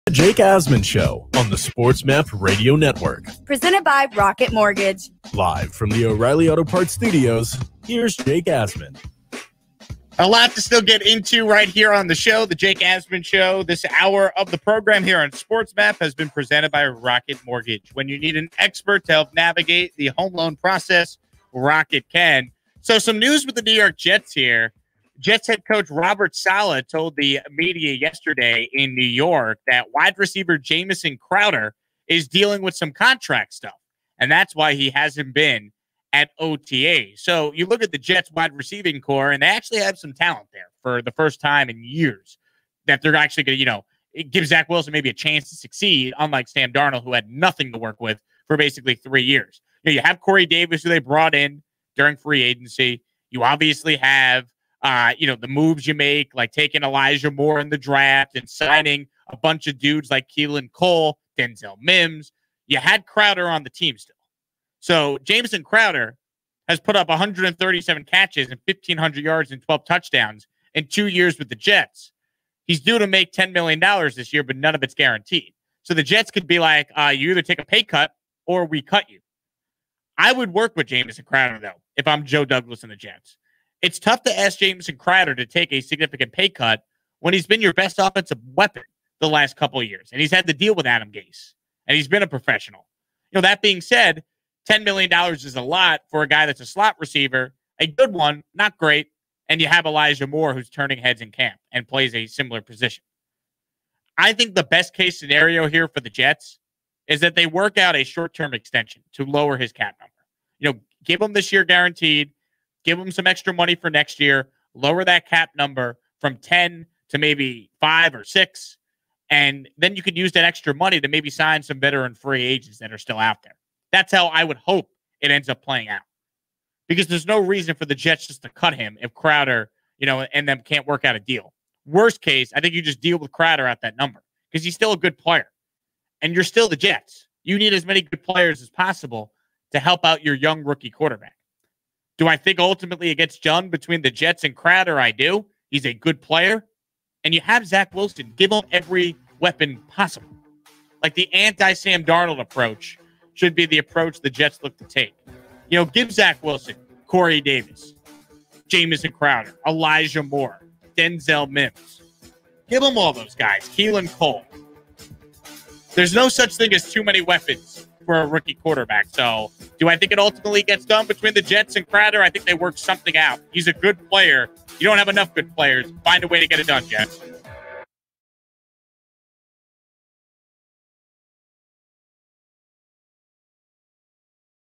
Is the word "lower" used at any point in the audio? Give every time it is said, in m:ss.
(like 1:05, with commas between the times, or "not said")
1:49, 1:54.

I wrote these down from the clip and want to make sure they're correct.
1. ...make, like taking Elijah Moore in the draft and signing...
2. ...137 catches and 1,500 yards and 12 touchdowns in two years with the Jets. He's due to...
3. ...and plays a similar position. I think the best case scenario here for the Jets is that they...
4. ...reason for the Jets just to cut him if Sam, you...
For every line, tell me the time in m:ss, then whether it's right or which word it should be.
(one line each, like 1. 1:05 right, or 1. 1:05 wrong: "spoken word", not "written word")
1. 0:55 right
2. 1:07 right
3. 1:41 right
4. 2:07 wrong: "Crowder", not "Sam".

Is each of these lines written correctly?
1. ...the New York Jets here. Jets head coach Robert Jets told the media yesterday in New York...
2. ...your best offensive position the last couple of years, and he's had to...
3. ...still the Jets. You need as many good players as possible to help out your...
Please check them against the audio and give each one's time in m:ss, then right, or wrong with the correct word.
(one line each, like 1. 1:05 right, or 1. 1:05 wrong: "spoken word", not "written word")
1. 0:23 wrong: "Saleh", not "Jets"
2. 1:27 wrong: "weapon", not "position"
3. 2:16 right.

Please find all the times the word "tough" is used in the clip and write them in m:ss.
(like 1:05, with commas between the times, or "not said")
1:23.